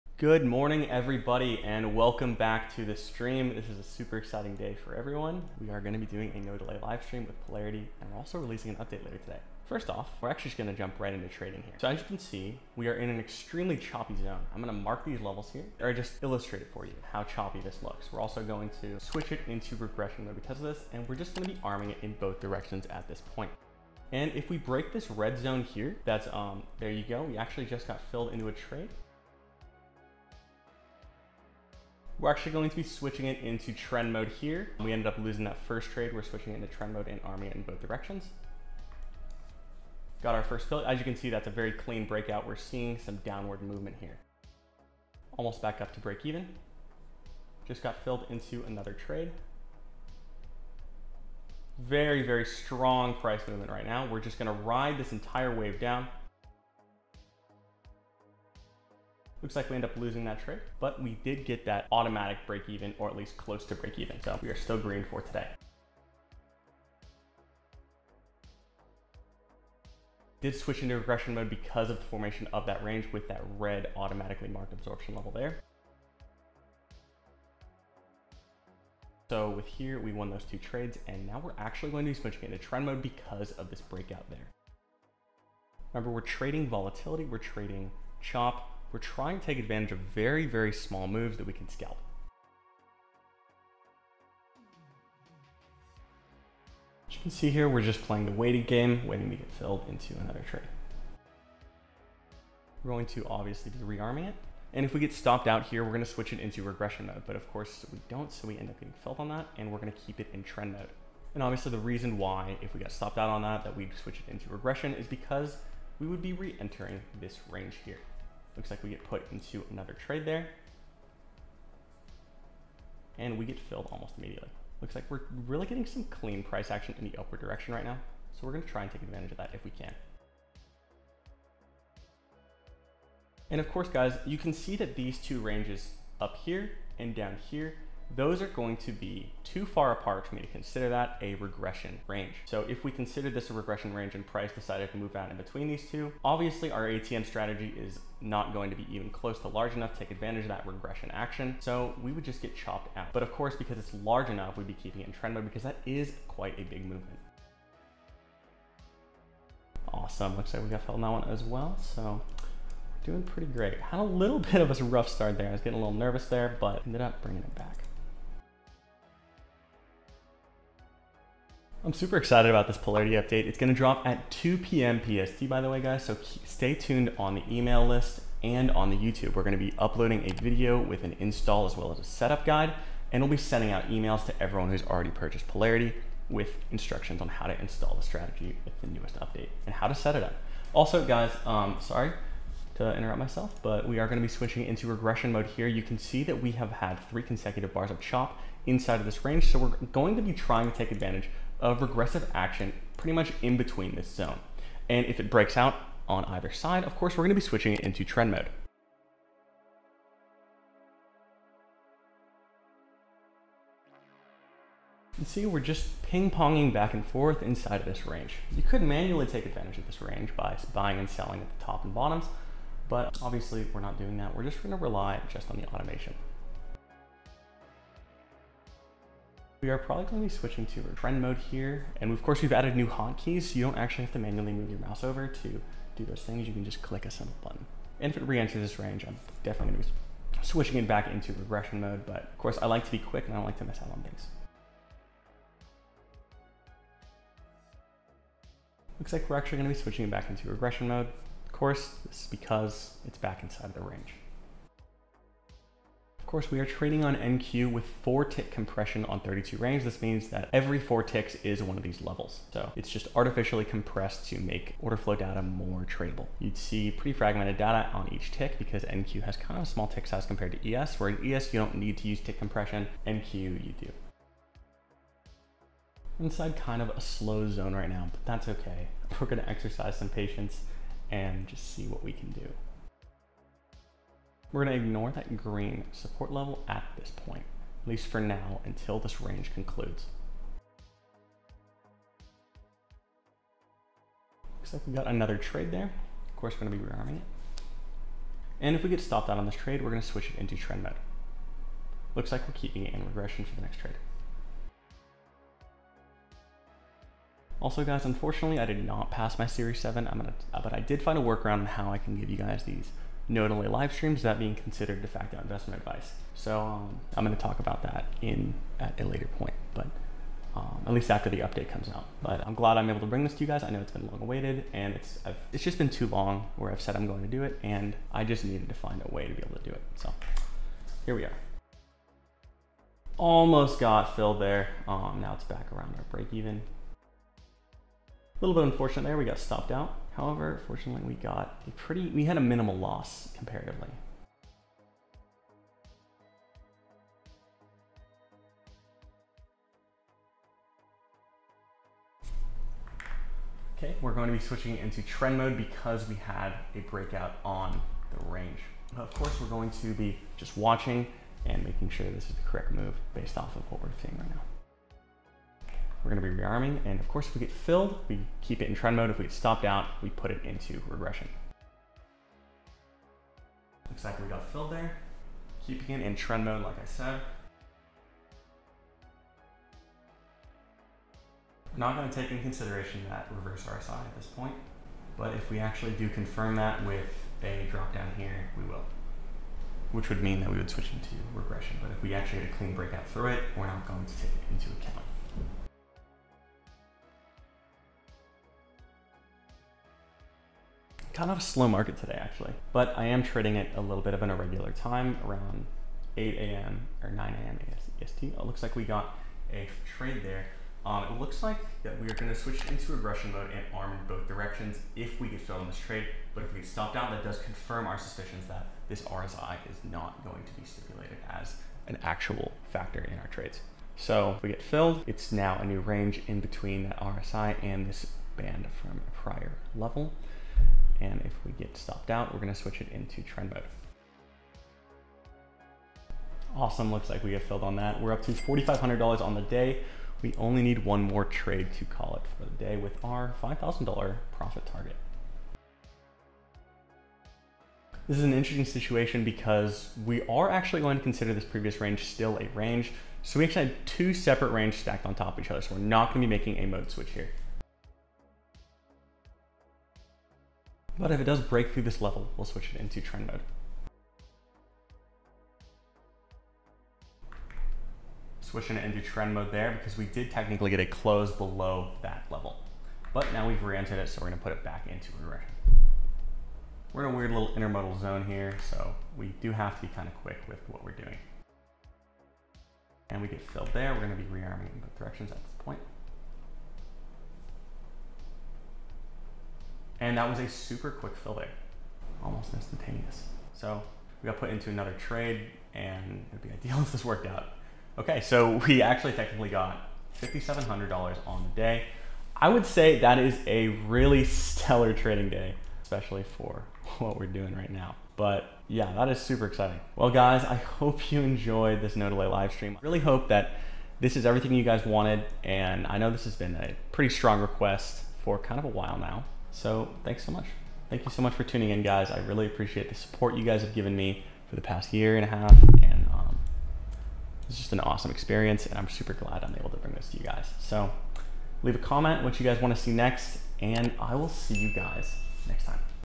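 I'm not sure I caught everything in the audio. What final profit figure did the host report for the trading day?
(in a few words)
$5,700.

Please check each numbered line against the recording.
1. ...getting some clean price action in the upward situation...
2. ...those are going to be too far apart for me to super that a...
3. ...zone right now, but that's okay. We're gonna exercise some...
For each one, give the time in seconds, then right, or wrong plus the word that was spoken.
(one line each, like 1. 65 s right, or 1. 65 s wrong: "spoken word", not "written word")
1. 125 s wrong: "direction", not "situation"
2. 138 s wrong: "consider", not "super"
3. 277 s right.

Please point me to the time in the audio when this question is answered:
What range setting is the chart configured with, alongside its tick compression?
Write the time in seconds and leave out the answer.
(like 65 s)
259 s.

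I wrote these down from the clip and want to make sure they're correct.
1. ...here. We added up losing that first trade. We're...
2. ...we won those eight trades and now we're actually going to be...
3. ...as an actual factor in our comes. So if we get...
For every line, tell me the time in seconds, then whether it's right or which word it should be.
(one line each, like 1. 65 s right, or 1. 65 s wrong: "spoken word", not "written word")
1. 34 s wrong: "ended", not "added"
2. 79 s wrong: "two", not "eight"
3. 421 s wrong: "trades", not "comes".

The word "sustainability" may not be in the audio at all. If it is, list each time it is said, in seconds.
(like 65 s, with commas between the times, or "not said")
not said.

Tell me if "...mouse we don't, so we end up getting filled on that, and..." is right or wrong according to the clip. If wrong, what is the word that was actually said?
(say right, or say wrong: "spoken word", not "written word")
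wrong: "course", not "mouse".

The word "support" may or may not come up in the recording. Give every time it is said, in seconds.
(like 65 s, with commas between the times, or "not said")
285 s, 522 s.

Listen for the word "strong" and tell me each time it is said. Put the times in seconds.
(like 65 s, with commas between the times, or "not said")
52 s, 517 s.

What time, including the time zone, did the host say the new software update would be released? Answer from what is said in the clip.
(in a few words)
2 p.m. PST.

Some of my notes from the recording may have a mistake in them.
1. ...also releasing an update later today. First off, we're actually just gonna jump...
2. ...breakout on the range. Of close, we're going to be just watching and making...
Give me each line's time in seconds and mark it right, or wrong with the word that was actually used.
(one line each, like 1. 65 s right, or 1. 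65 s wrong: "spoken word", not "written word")
1. 8 s right
2. 356 s wrong: "course", not "close".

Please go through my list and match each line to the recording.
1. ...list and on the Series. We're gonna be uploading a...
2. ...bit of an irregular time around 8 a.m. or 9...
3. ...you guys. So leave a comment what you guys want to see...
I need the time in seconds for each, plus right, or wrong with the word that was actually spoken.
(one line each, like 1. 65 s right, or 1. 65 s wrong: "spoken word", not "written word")
1. 177 s wrong: "YouTube", not "Series"
2. 404 s right
3. 530 s right.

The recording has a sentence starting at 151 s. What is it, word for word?
So we would just get chopped out.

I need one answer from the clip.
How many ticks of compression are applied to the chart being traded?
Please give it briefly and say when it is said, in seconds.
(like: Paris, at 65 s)
4, at 258 s.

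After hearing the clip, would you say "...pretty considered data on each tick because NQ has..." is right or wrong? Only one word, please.
wrong.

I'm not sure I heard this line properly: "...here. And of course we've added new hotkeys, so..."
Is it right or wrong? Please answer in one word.
right.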